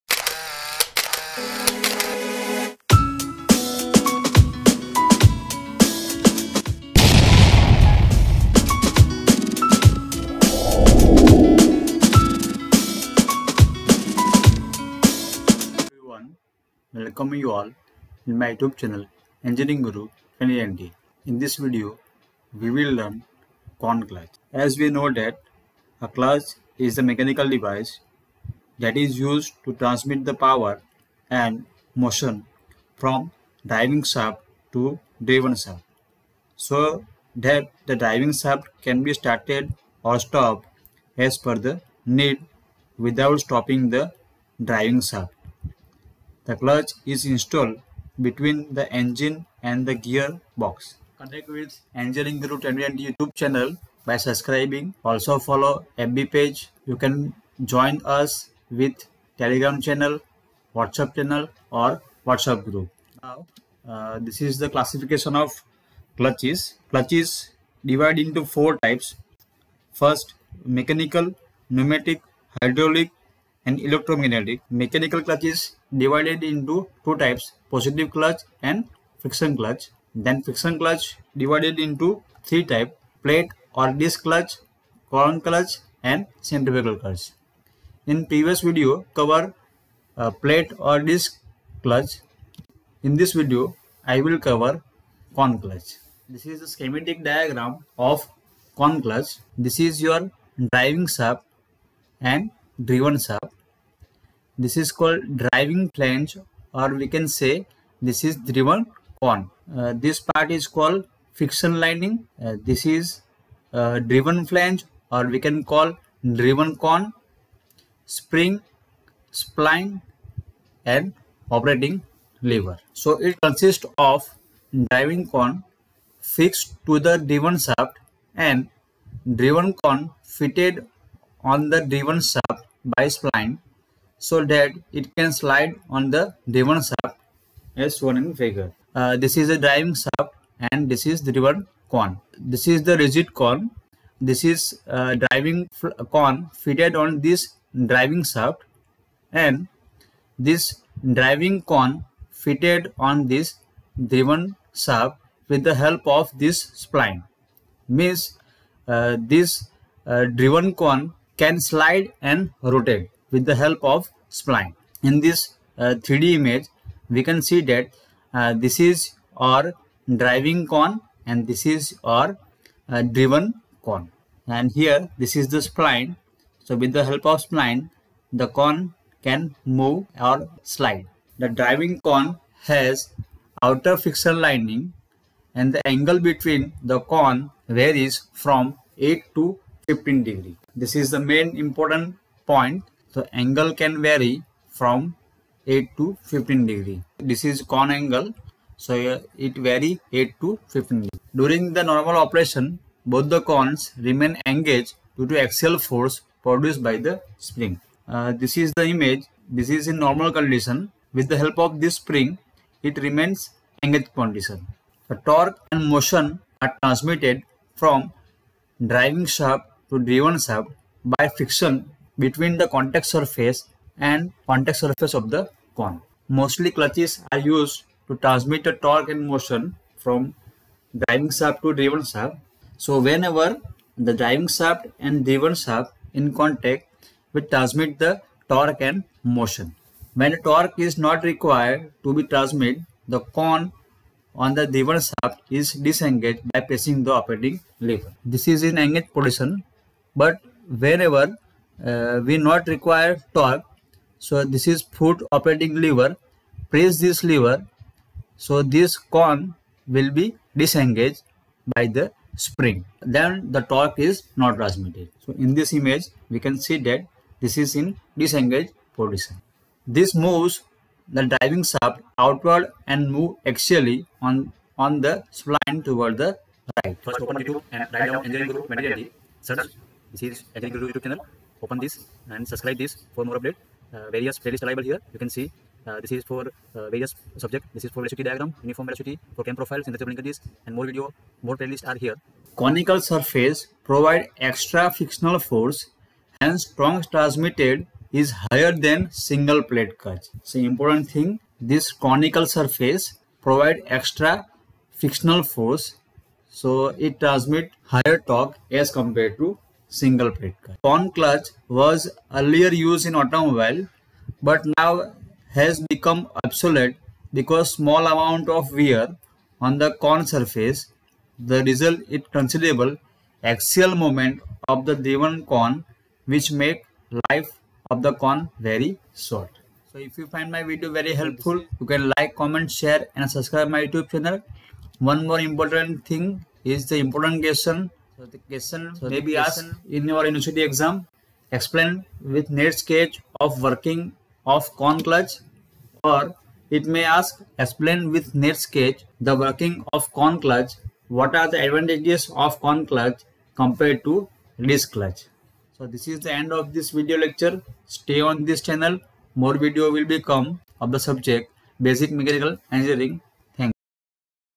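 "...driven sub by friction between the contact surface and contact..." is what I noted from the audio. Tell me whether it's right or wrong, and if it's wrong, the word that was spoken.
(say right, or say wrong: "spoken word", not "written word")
right.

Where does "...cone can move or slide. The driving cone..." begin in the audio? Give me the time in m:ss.
2:58.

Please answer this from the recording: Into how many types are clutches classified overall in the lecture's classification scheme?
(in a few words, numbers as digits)
4.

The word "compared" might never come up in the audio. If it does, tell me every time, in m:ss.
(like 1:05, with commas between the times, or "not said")
5:08, 5:53.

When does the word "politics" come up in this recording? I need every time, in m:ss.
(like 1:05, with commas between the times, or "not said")
not said.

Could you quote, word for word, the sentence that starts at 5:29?
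So if you find my video very helpful, you can like, comment, share and subscribe my YouTube channel.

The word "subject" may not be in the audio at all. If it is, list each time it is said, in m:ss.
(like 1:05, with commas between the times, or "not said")
4:47, 6:00.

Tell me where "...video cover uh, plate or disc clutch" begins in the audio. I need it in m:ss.
1:28.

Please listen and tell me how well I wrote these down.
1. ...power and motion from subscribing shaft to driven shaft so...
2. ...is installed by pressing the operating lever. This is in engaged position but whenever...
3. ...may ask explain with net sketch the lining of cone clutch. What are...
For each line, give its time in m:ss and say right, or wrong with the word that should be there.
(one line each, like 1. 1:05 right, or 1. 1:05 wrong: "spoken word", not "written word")
1. 0:30 wrong: "driving", not "subscribing"
2. 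4:05 wrong: "disengaged", not "installed"
3. 5:46 wrong: "working", not "lining".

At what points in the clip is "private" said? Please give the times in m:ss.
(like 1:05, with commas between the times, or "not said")
not said.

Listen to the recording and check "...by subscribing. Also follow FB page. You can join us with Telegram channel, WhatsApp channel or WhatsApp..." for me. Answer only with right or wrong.
right.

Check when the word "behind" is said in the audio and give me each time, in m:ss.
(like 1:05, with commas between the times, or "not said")
not said.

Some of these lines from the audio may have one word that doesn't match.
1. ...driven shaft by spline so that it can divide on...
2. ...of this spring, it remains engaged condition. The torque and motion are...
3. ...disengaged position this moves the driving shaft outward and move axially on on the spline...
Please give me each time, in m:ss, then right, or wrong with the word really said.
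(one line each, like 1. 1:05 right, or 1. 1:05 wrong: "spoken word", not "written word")
1. 2:11 wrong: "slide", not "divide"
2. 3:31 right
3. 4:28 right.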